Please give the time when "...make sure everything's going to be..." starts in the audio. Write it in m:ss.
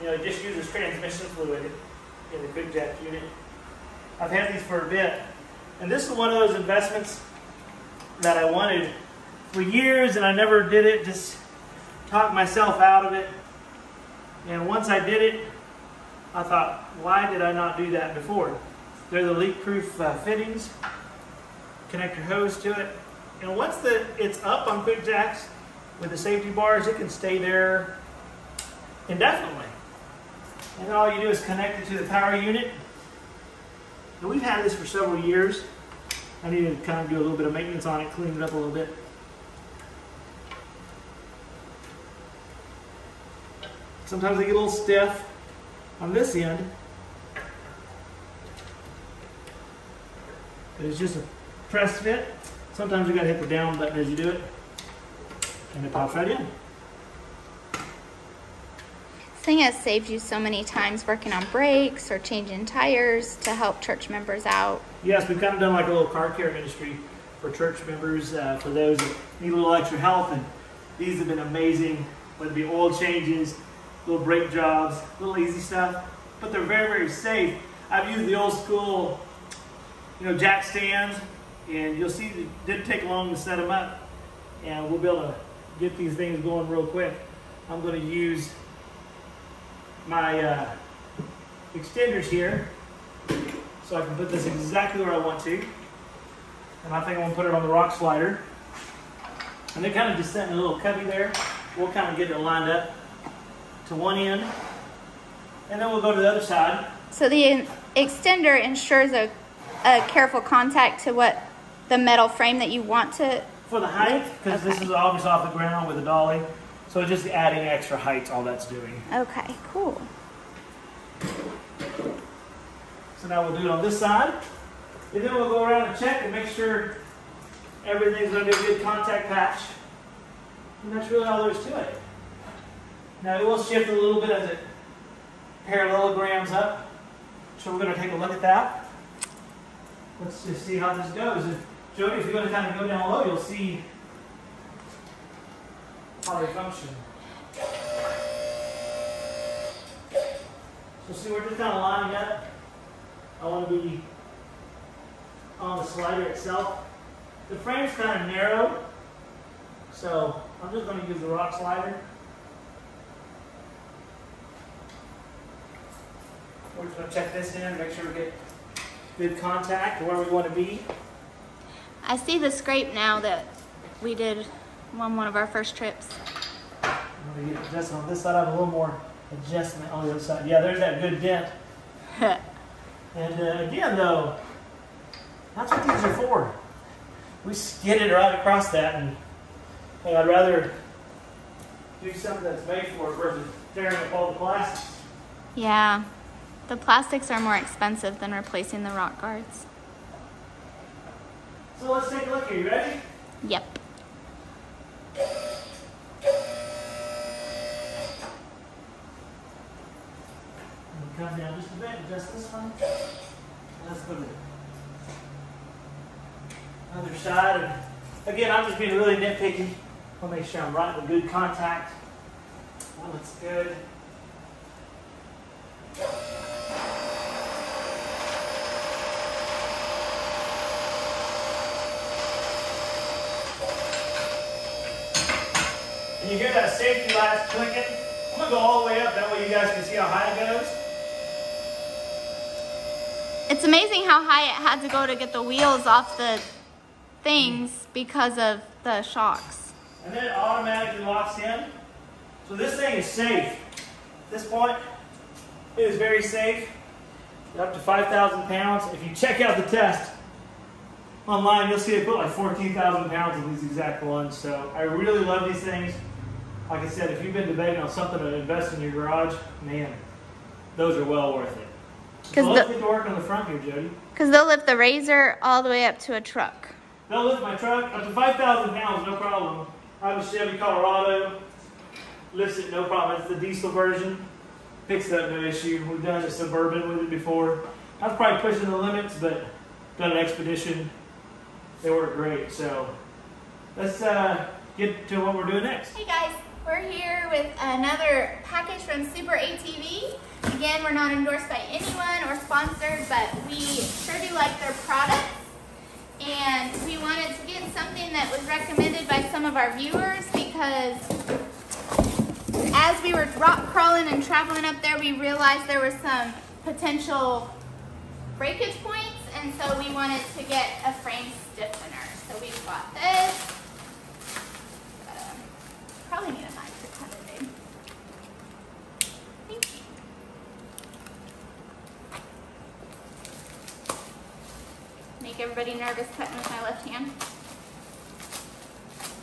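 2:06.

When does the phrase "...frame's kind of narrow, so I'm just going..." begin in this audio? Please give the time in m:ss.
2:37.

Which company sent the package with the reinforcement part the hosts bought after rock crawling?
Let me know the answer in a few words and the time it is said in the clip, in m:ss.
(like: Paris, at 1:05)
Super ATV, at 4:59.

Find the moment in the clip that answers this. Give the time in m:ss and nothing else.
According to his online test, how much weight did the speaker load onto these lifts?
4:22.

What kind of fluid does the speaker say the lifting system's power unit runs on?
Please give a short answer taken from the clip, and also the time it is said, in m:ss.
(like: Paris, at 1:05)
transmission fluid, at 0:00.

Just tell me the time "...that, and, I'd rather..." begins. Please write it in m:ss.
3:08.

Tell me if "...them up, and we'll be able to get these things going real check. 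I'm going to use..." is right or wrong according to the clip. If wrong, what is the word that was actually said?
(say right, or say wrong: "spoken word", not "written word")
wrong: "quick", not "check".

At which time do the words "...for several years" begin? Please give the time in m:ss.
0:34.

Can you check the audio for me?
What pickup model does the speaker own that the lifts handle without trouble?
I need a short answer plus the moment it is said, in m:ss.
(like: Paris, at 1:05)
Chevy Colorado, at 4:40.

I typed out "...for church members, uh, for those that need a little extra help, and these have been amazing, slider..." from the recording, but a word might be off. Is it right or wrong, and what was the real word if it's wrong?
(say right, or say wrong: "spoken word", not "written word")
wrong: "whether", not "slider".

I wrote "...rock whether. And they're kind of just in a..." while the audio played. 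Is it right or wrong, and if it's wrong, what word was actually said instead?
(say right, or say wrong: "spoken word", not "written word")
wrong: "slider", not "whether".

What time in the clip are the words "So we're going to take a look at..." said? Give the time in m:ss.
2:17.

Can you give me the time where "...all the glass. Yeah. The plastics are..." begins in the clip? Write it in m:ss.
3:14.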